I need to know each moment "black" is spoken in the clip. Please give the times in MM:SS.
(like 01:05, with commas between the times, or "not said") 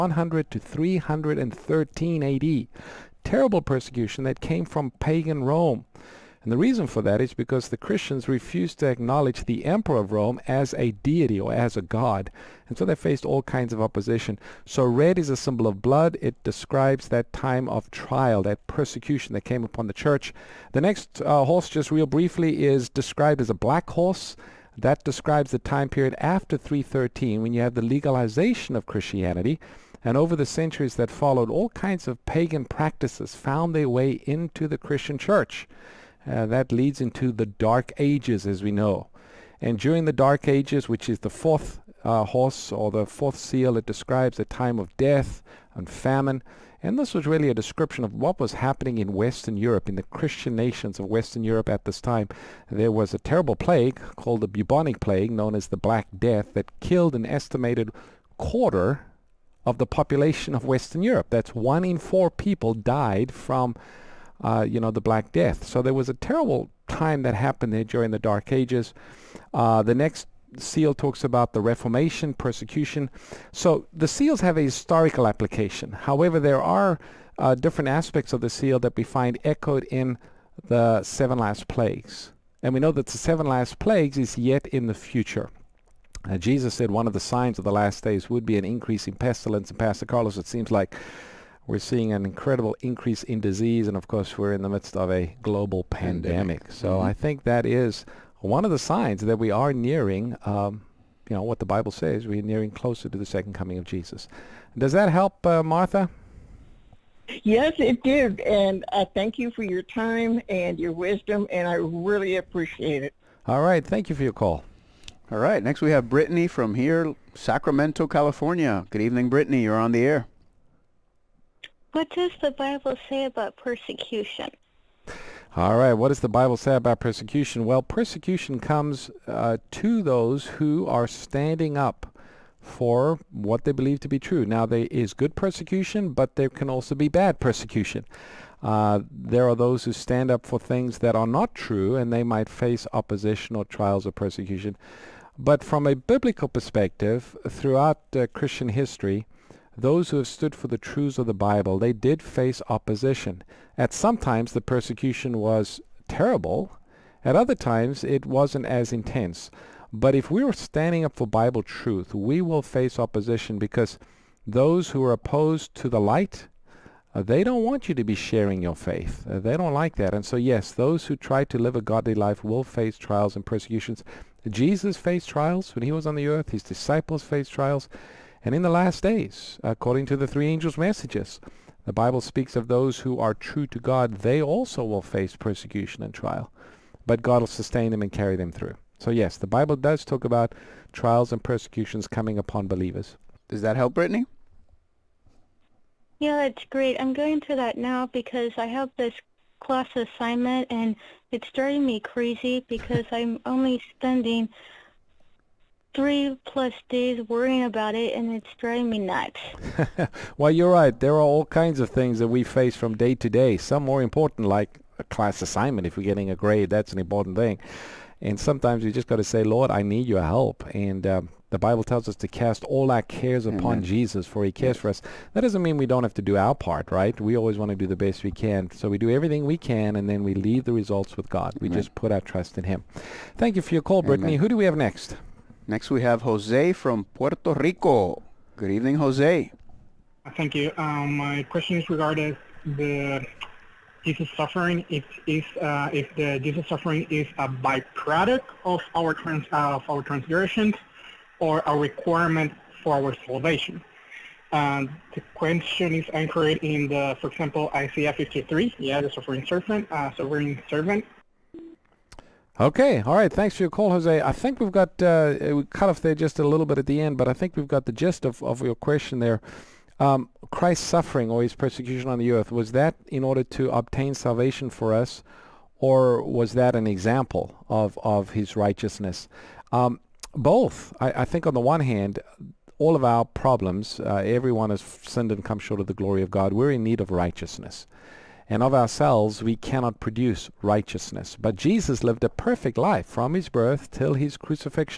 00:23, 00:55, 01:04.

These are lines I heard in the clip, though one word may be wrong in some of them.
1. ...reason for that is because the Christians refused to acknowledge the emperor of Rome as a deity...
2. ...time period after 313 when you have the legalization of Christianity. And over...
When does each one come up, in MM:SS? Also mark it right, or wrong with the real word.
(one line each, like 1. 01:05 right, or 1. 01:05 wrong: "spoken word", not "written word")
1. 00:06 right
2. 00:25 right.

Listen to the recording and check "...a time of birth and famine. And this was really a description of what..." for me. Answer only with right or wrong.
wrong.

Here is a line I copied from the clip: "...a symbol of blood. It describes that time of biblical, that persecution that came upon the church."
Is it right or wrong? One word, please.
wrong.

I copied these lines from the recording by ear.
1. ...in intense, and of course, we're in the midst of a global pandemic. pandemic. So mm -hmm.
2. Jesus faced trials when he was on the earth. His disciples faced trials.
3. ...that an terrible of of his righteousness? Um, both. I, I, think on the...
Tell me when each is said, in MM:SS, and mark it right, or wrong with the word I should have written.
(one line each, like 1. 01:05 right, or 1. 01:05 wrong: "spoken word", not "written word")
1. 01:33 wrong: "disease", not "intense"
2. 02:54 right
3. 04:36 wrong: "example", not "terrible".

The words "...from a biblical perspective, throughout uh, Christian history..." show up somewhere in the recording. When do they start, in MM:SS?
02:25.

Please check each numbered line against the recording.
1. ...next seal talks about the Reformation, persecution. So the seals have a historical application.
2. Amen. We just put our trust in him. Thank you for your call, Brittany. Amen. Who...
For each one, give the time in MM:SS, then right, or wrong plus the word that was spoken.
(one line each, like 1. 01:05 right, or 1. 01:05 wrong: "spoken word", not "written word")
1. 01:09 right
2. 03:51 right.